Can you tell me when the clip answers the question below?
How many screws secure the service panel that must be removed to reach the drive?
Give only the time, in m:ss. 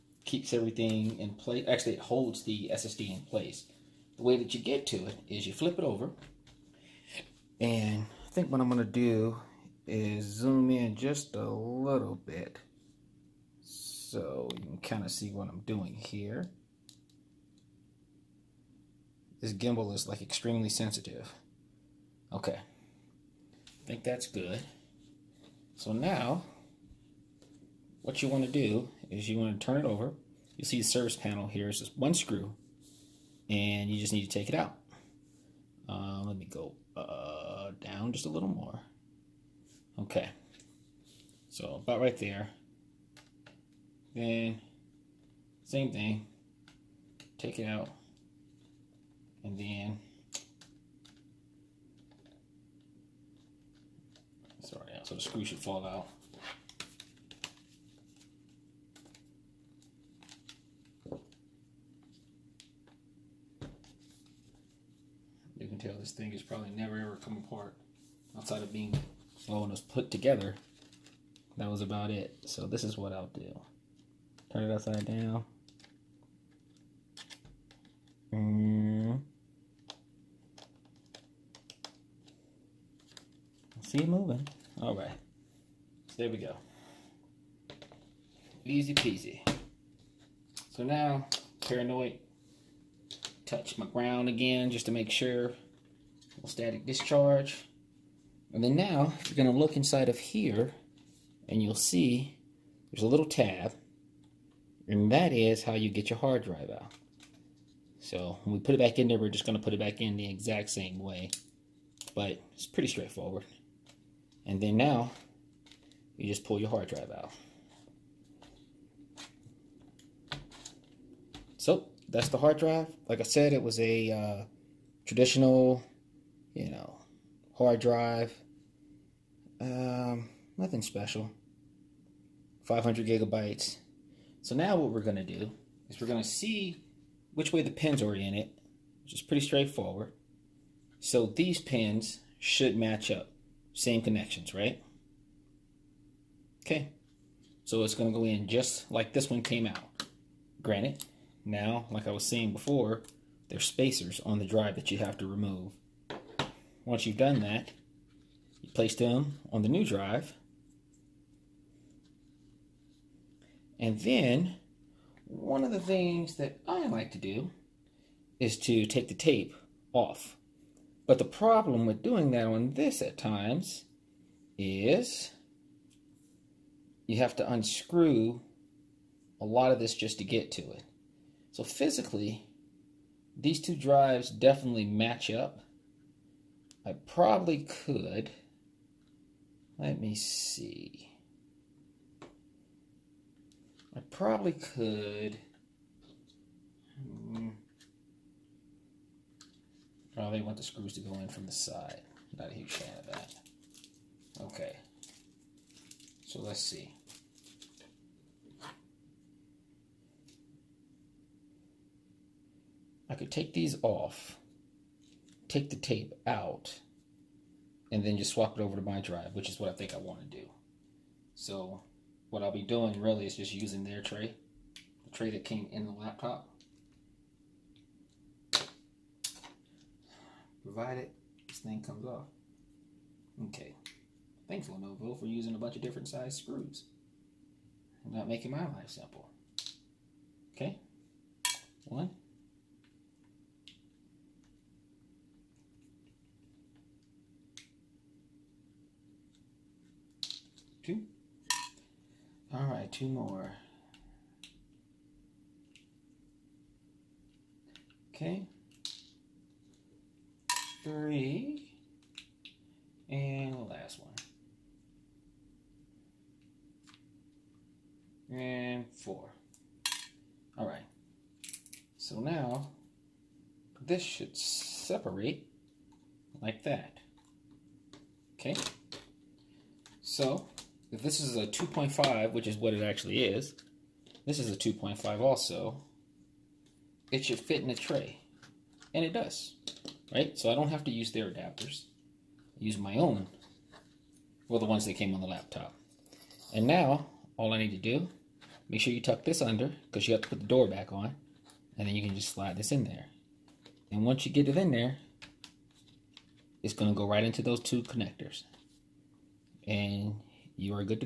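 0:31.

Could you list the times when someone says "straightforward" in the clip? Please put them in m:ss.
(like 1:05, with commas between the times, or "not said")
1:52, 2:19.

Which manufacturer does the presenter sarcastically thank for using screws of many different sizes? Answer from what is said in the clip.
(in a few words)
Lenovo.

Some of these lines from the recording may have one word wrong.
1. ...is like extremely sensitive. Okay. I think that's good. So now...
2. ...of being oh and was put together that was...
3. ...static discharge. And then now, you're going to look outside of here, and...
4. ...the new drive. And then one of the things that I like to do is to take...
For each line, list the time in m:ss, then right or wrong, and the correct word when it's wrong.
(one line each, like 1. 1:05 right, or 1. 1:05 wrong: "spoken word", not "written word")
1. 0:19 right
2. 1:08 right
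3. 1:36 wrong: "inside", not "outside"
4. 2:39 right.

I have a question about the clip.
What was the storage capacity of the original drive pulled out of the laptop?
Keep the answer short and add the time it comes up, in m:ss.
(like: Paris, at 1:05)
500 gigabytes, at 2:12.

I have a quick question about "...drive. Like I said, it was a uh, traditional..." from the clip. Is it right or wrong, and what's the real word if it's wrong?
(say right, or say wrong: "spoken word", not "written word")
right.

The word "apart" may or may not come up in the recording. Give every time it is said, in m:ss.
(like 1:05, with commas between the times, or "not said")
1:07.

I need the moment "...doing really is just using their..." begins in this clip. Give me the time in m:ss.
3:42.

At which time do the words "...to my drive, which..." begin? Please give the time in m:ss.
3:38.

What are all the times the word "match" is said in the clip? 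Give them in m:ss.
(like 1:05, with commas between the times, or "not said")
2:22, 3:04.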